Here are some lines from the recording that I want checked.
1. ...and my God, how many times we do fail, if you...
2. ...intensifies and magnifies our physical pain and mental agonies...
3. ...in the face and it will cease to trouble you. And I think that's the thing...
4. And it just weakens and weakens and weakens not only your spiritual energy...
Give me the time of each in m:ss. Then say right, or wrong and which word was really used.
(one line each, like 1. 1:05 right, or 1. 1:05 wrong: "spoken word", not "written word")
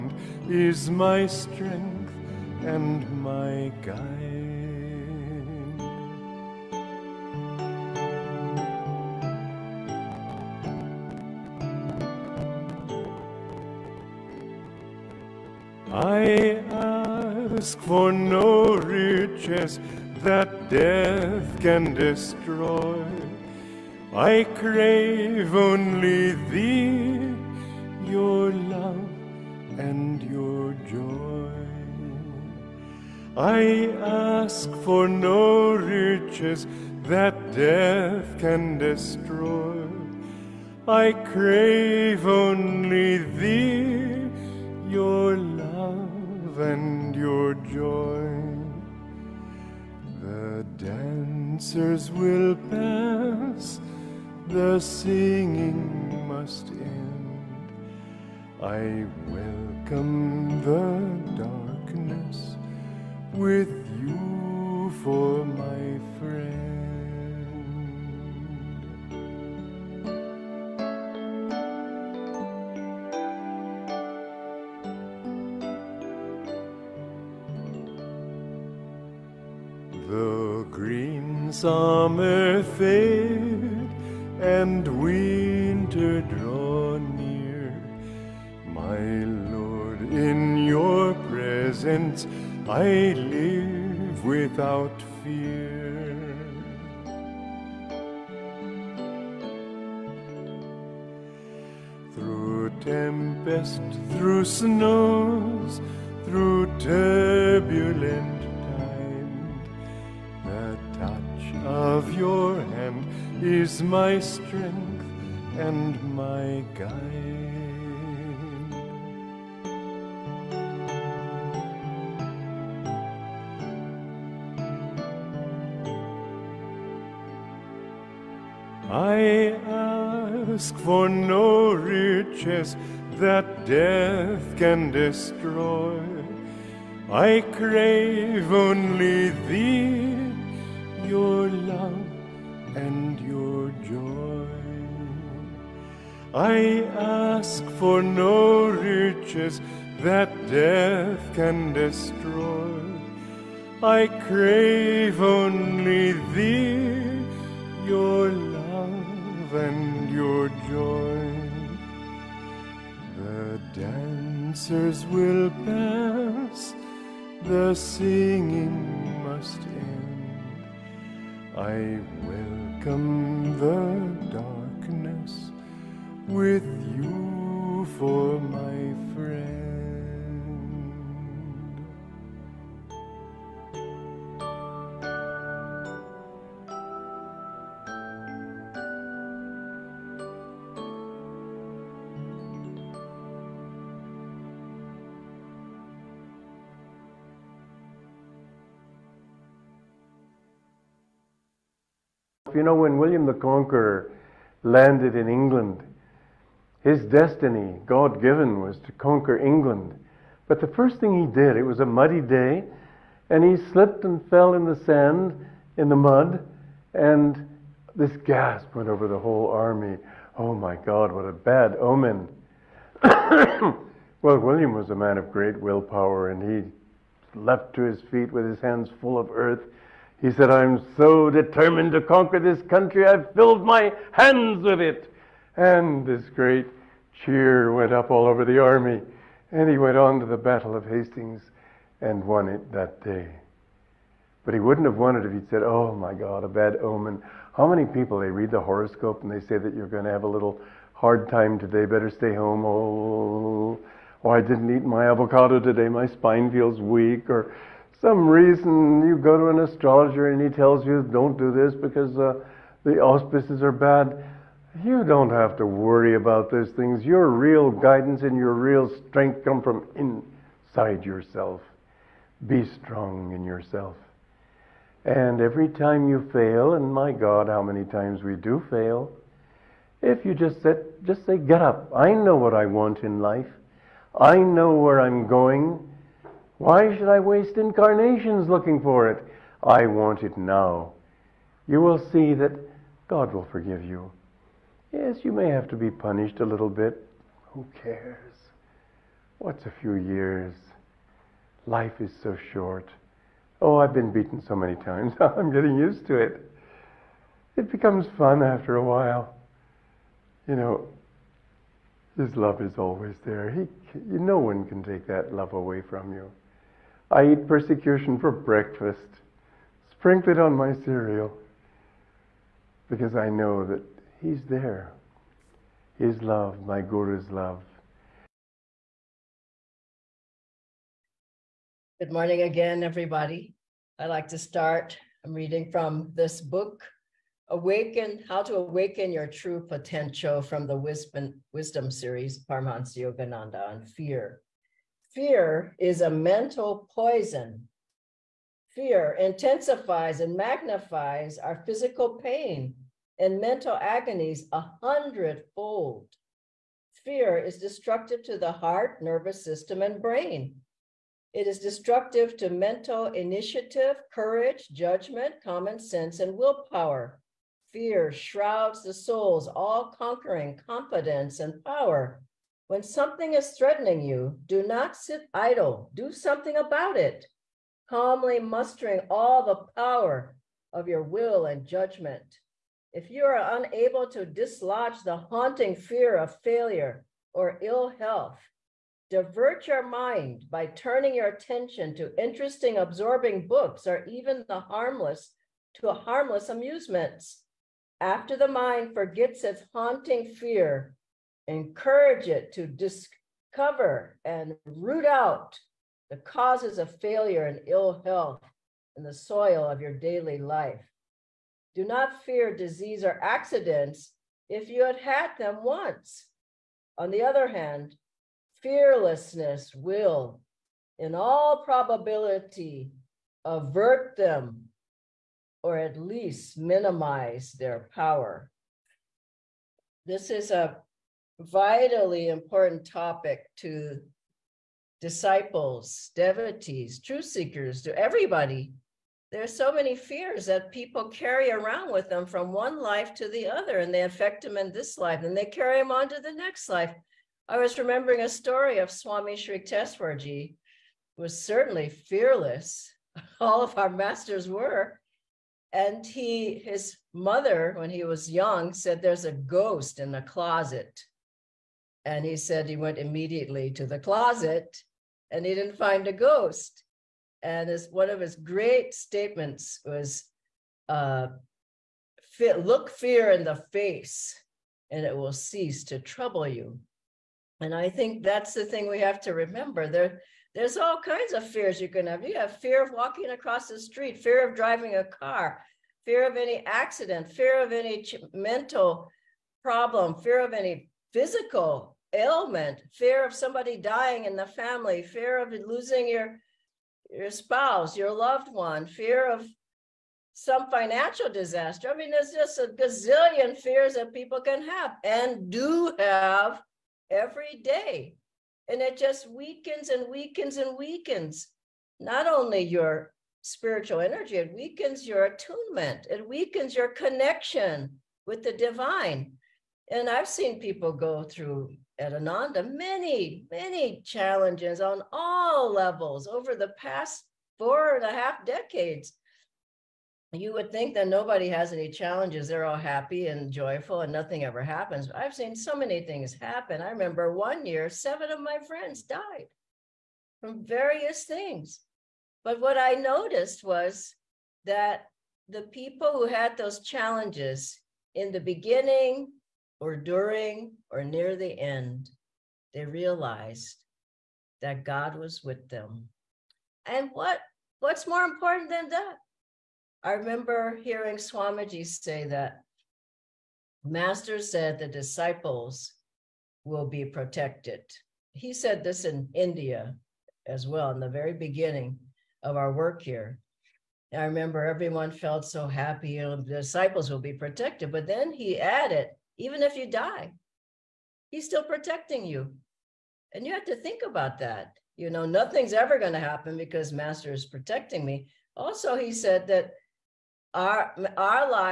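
1. 4:36 right
2. 5:49 right
3. 7:53 right
4. 8:28 right.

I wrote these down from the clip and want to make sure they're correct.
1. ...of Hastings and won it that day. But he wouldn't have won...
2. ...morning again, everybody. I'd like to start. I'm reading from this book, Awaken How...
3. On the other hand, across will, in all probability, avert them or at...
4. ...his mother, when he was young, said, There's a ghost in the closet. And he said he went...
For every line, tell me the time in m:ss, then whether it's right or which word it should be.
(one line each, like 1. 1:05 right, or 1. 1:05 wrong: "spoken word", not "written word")
1. 4:00 right
2. 5:32 right
3. 6:56 wrong: "fearlessness", not "across"
4. 7:36 right.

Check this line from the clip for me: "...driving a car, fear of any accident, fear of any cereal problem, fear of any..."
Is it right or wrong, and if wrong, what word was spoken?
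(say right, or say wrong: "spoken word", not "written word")
wrong: "mental", not "cereal".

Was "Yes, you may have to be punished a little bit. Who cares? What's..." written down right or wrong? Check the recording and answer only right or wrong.
right.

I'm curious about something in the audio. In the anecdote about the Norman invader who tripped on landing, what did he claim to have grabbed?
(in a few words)
This country.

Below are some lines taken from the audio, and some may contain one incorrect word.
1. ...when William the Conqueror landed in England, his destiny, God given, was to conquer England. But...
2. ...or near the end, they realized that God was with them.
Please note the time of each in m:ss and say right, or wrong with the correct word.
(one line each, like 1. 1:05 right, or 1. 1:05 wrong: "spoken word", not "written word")
1. 3:22 right
2. 9:10 right.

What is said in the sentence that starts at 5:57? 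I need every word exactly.
Fear is destructive to the heart, nervous system, and brain.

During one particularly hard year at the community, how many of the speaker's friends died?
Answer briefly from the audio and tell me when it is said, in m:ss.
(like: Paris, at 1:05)
7, at 8:57.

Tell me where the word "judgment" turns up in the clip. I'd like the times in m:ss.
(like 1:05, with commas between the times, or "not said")
6:04, 6:21.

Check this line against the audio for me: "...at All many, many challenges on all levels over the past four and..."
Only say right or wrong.
wrong.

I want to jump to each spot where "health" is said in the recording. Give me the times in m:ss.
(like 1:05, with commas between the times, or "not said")
6:27, 6:48.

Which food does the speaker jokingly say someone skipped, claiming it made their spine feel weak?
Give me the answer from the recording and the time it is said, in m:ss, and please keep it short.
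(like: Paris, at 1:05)
Avocado, at 4:15.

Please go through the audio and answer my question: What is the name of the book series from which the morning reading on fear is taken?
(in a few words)
Wisdom Series.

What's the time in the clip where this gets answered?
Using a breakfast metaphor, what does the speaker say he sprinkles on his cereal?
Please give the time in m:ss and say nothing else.
5:17.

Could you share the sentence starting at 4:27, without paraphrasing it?
Your real guidance and your real strength come from inside yourself.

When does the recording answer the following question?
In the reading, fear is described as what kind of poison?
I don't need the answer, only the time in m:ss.
5:46.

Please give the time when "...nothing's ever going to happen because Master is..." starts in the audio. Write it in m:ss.
9:45.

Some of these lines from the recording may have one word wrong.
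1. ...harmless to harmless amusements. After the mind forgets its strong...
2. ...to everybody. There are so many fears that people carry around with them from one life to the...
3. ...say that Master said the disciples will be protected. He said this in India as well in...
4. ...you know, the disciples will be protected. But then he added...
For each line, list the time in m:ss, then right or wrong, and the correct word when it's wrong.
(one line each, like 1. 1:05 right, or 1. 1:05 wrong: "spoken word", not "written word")
1. 6:34 wrong: "haunting", not "strong"
2. 7:17 right
3. 9:21 right
4. 9:36 right.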